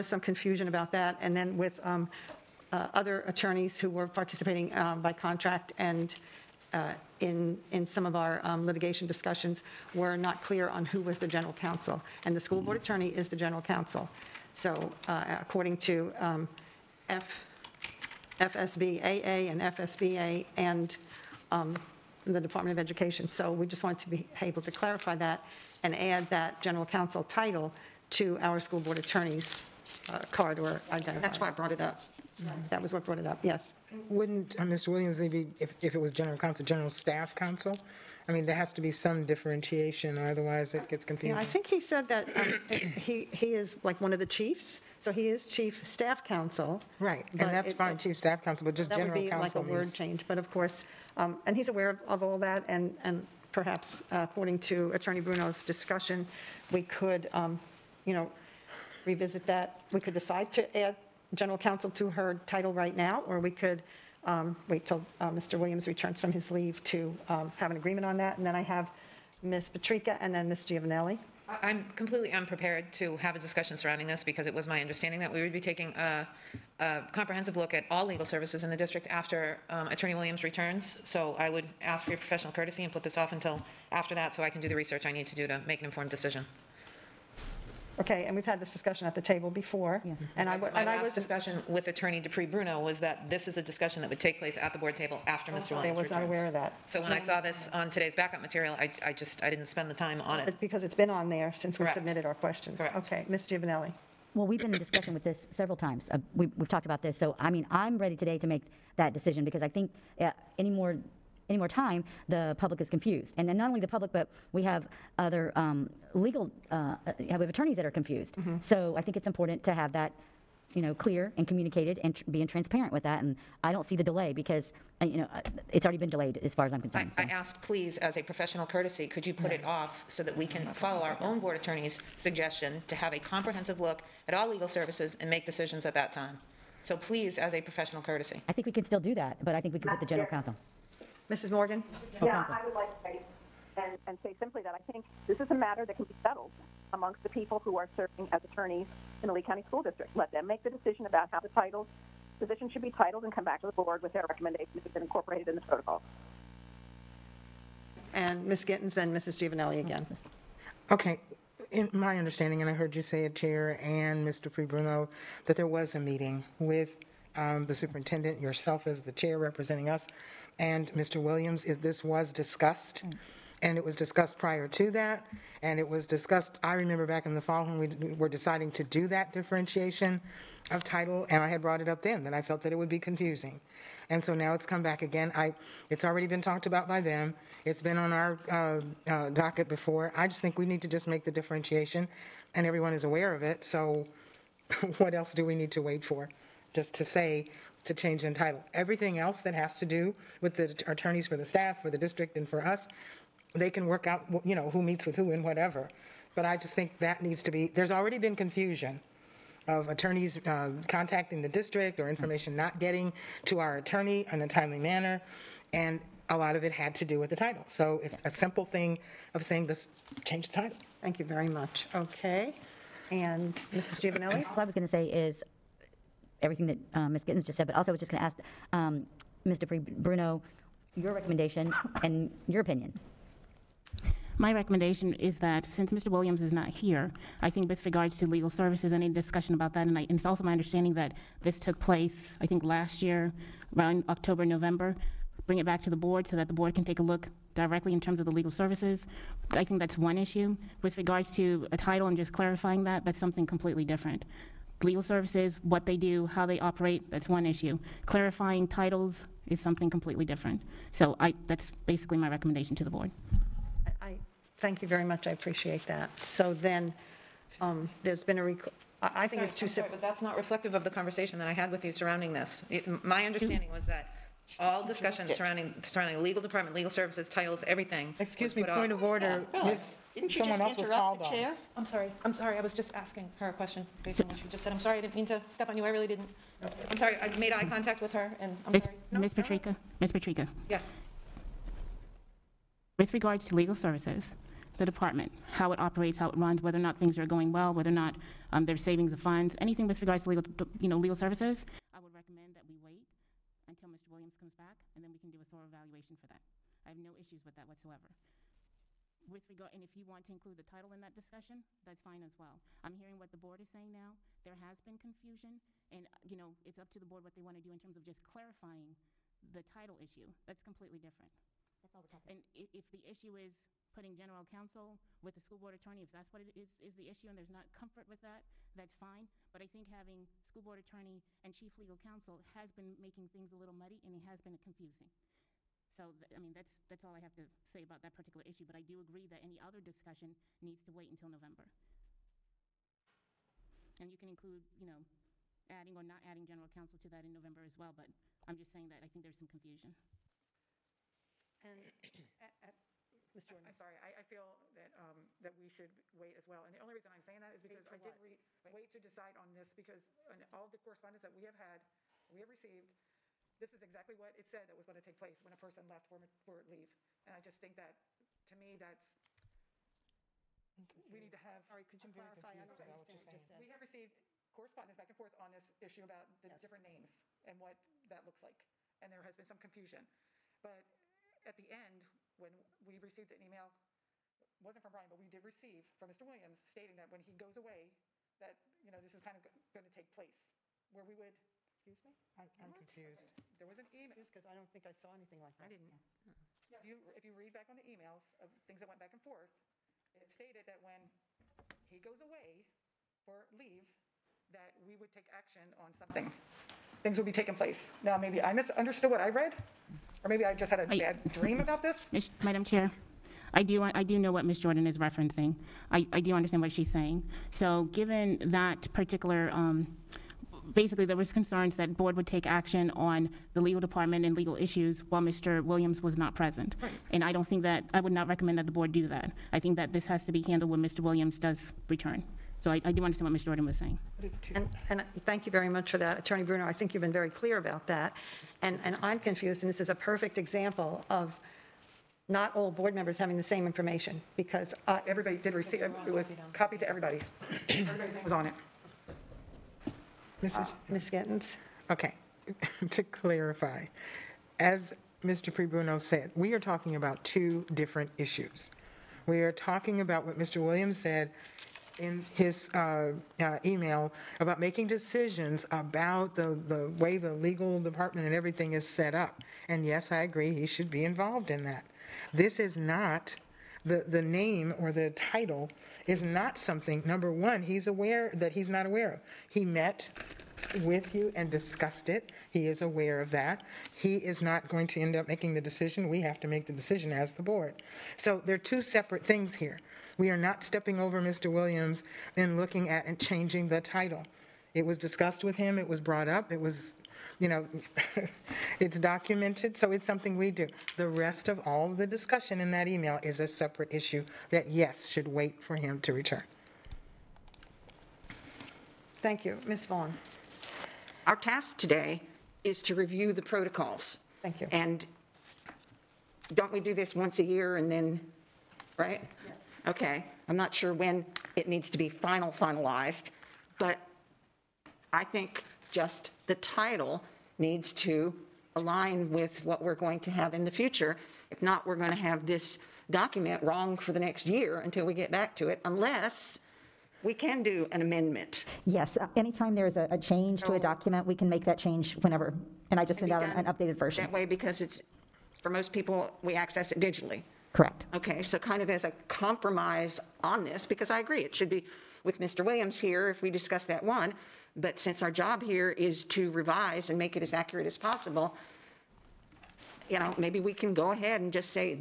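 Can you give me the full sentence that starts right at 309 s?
With regard, and if you want to include the title in that discussion, that's fine as well.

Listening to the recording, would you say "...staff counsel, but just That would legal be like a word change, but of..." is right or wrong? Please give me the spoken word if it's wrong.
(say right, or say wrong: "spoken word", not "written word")
wrong: "general", not "legal".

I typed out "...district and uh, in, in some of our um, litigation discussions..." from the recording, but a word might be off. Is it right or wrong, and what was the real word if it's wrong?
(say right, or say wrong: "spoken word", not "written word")
wrong: "contract", not "district".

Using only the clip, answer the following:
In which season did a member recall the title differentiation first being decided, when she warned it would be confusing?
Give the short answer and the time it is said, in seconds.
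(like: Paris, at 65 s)
fall, at 177 s.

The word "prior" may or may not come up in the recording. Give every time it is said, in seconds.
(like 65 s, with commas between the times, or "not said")
174 s.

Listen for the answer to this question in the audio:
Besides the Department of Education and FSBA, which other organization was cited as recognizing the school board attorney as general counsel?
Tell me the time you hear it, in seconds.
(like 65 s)
18 s.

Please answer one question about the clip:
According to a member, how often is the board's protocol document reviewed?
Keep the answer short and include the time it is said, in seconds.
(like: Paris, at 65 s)
once a year, at 517 s.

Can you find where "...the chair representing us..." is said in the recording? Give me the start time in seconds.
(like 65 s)
168 s.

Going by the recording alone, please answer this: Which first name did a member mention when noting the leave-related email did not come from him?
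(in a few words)
Brian.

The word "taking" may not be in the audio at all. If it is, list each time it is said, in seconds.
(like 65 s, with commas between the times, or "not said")
75 s, 407 s.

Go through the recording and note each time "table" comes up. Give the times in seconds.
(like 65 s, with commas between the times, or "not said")
89 s, 94 s.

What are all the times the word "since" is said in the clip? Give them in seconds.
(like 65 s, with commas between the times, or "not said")
101 s, 235 s, 554 s.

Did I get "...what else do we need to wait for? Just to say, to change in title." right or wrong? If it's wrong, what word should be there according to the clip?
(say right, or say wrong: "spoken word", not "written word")
right.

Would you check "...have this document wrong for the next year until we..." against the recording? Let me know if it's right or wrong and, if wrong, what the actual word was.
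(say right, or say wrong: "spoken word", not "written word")
right.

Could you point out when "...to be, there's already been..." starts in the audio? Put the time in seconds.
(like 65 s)
207 s.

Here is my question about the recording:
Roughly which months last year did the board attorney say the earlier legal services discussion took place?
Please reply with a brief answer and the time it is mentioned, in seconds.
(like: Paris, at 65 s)
October, November, at 244 s.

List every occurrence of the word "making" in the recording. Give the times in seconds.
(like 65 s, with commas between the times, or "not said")
333 s, 464 s, 485 s.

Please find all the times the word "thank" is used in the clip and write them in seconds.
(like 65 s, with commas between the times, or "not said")
221 s, 264 s, 435 s, 509 s, 514 s.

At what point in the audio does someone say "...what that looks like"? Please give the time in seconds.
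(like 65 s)
377 s.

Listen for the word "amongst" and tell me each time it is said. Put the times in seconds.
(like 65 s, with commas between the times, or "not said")
146 s.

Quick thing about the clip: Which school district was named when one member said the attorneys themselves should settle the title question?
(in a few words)
Lee County.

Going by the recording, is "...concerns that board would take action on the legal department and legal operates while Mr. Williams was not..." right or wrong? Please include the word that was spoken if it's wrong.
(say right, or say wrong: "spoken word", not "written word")
wrong: "issues", not "operates".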